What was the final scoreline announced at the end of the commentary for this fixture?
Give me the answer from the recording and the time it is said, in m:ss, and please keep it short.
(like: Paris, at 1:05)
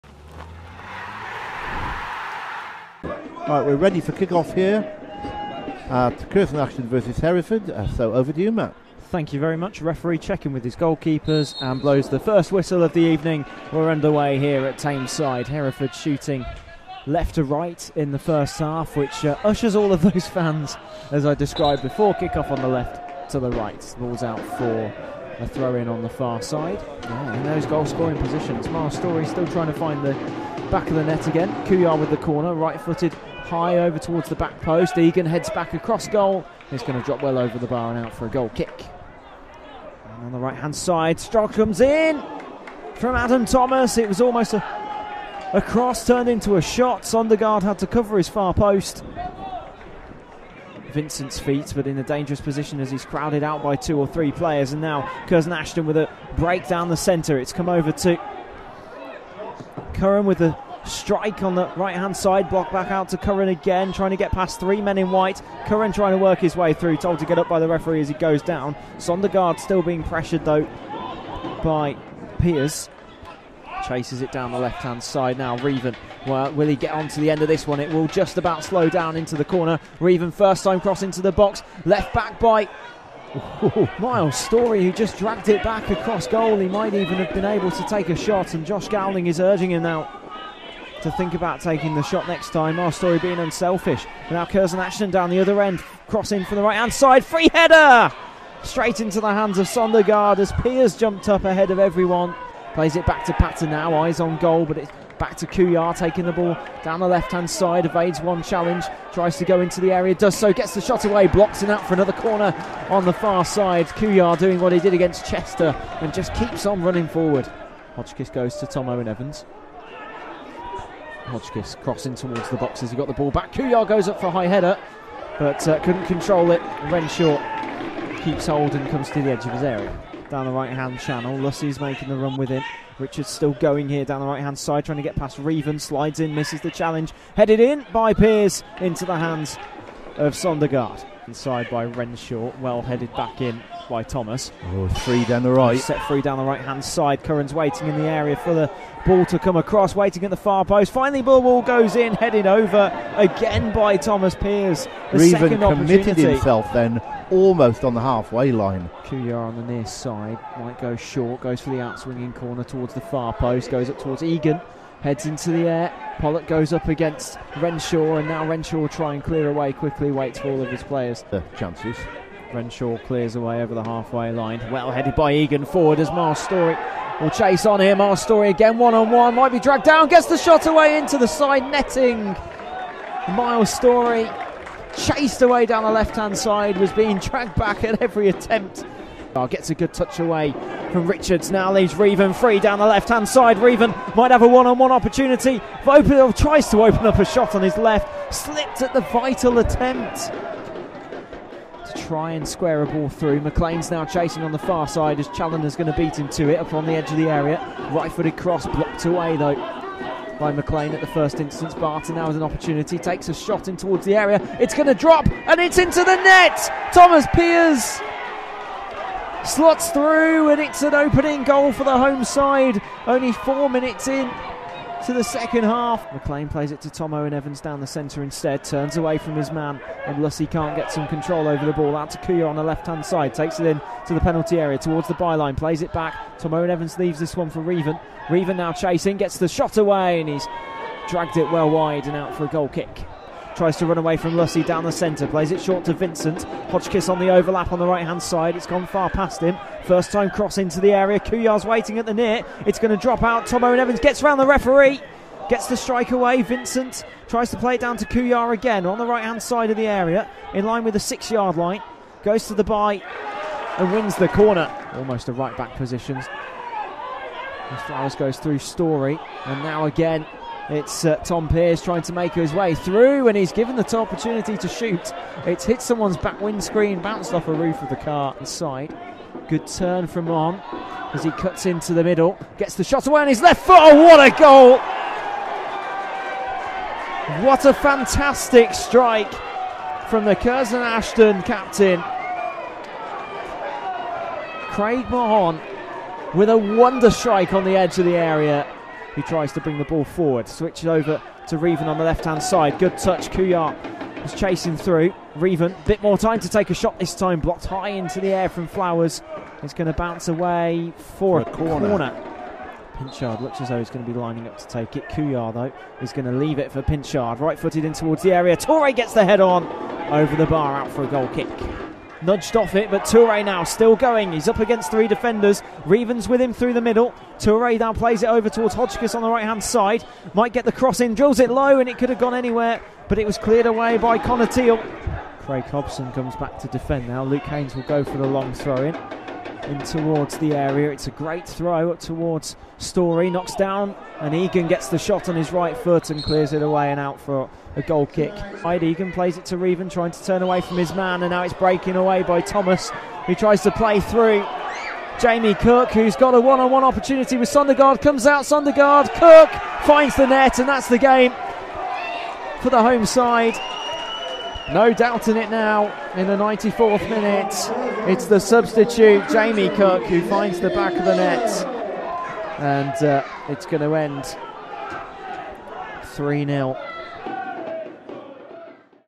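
3-0, at 6:16.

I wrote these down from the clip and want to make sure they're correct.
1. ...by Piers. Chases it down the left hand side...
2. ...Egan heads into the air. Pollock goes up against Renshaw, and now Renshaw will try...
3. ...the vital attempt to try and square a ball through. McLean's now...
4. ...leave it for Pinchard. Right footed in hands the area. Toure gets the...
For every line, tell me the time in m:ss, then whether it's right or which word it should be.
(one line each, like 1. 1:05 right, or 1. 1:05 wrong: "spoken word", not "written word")
1. 1:11 right
2. 2:44 right
3. 3:18 right
4. 5:16 wrong: "towards", not "hands".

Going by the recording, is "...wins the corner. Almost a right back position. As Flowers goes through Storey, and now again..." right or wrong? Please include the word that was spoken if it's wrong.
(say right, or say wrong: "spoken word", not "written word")
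right.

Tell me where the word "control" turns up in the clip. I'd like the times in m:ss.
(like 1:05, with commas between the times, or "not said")
2:06, 3:51.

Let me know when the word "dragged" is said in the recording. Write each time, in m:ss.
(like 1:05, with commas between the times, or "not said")
1:25, 2:59, 3:07, 4:01.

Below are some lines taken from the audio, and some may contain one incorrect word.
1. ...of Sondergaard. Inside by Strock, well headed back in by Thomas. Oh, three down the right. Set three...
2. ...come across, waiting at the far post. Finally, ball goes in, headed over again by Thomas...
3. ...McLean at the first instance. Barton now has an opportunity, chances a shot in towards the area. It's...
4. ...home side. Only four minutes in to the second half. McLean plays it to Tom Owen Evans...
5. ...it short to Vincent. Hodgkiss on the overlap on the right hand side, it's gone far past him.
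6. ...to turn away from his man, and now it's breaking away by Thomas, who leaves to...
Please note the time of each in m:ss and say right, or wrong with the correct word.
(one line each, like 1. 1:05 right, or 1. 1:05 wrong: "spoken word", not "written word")
1. 2:20 wrong: "Renshaw", not "Strock"
2. 2:29 right
3. 3:30 wrong: "takes", not "chances"
4. 3:41 right
5. 4:05 right
6. 5:50 wrong: "tries", not "leaves".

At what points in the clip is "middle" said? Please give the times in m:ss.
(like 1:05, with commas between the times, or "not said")
4:42, 5:26.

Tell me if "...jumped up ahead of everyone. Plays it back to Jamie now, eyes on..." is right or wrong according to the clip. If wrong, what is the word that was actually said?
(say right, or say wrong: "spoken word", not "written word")
wrong: "Patton", not "Jamie".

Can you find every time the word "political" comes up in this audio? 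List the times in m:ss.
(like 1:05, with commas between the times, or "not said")
not said.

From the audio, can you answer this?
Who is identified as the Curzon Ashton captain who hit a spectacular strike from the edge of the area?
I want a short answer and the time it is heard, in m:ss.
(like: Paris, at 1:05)
Craig Mahon, at 4:54.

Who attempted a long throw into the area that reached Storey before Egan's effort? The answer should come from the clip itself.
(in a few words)
Luke Haynes.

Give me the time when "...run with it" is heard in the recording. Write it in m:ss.
2:12.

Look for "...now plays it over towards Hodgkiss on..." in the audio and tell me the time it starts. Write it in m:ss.
5:27.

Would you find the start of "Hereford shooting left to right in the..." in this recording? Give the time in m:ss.
0:15.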